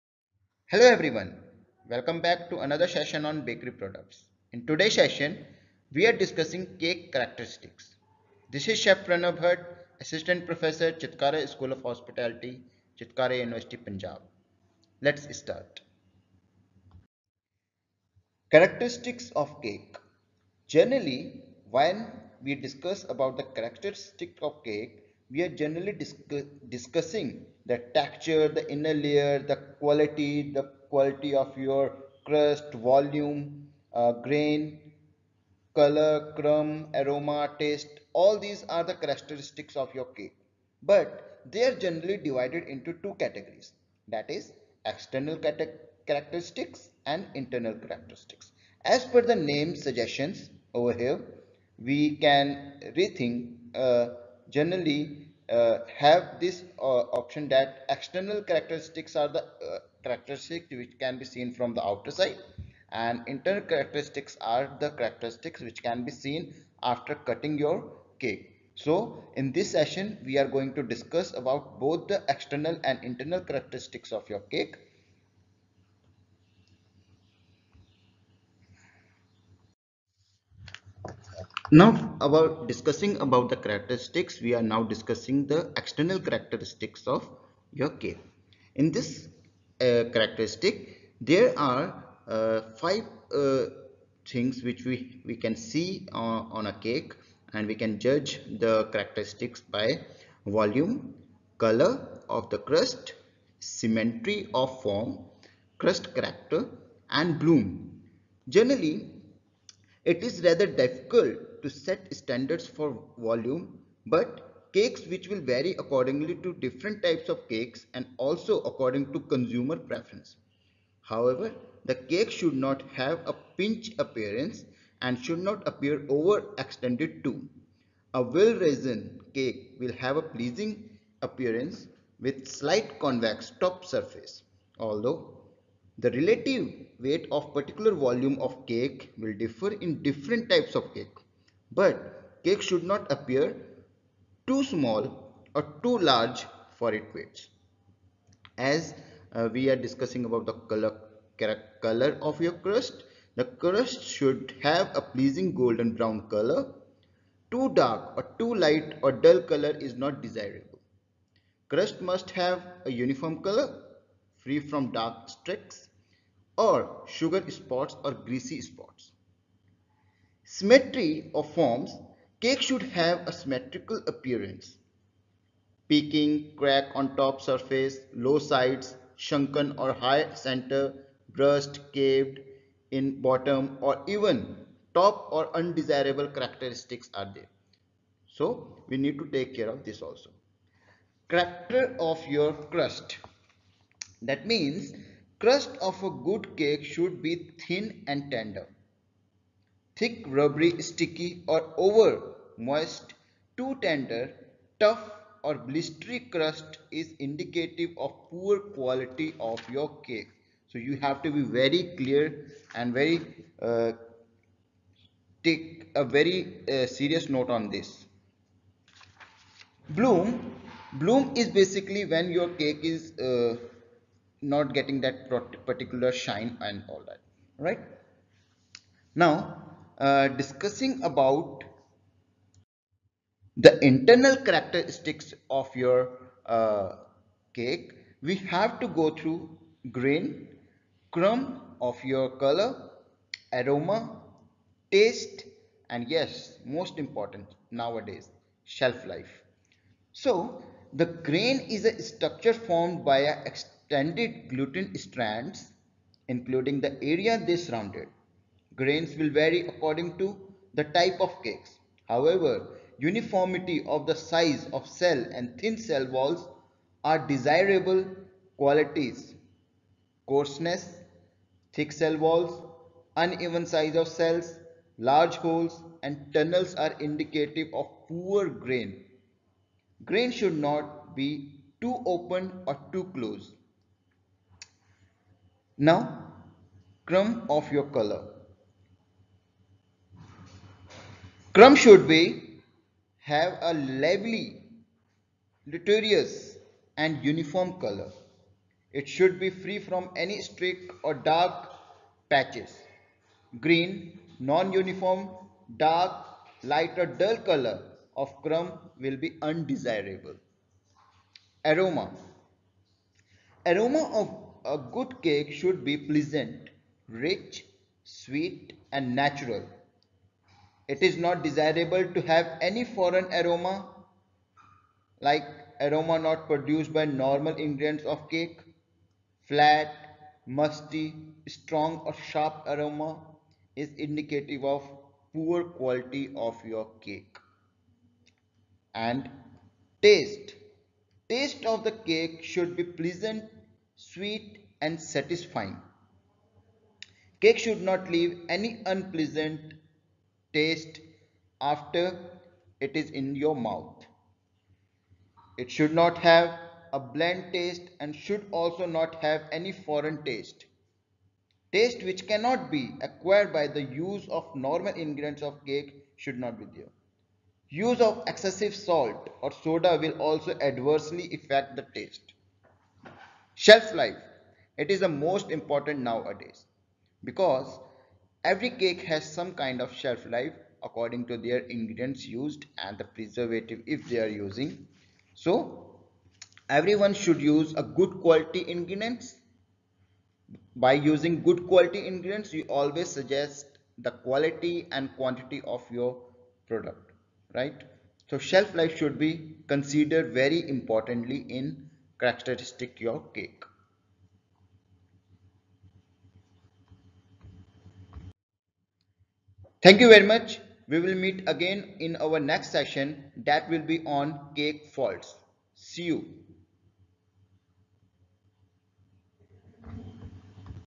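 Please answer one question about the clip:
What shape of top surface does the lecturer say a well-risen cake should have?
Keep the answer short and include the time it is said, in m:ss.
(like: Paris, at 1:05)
slight convex, at 2:12.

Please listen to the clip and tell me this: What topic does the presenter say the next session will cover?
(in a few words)
cake faults.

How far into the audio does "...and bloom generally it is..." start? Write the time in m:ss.
1:47.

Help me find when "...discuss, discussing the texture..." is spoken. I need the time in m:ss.
0:25.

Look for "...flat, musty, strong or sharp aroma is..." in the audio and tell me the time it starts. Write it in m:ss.
5:29.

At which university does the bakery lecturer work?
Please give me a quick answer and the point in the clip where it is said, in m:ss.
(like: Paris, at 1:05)
Chitkara University, at 0:12.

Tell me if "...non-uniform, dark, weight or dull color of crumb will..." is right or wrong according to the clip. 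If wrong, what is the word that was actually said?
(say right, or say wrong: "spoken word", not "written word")
wrong: "light", not "weight".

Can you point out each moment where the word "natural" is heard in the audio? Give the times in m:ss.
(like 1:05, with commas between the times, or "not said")
5:19.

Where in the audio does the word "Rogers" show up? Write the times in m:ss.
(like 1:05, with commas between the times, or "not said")
not said.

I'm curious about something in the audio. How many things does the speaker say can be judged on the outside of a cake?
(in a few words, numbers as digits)
5.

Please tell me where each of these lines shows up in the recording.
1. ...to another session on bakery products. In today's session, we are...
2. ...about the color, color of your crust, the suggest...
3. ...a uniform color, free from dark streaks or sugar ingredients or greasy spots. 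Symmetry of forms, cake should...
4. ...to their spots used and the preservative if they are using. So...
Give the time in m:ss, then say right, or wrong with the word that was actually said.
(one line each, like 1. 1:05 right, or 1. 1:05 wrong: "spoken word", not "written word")
1. 0:02 right
2. 2:30 wrong: "crust", not "suggest"
3. 2:42 wrong: "spots", not "ingredients"
4. 6:21 wrong: "ingredients", not "spots".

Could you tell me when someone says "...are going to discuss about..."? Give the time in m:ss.
1:10.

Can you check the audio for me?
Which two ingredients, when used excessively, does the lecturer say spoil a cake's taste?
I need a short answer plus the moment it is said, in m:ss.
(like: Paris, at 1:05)
salt or soda, at 6:08.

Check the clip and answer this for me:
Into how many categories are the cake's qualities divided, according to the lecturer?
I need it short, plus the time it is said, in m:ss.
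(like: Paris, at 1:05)
2, at 0:43.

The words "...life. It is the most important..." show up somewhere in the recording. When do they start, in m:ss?
6:13.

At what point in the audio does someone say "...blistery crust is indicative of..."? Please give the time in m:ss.
3:25.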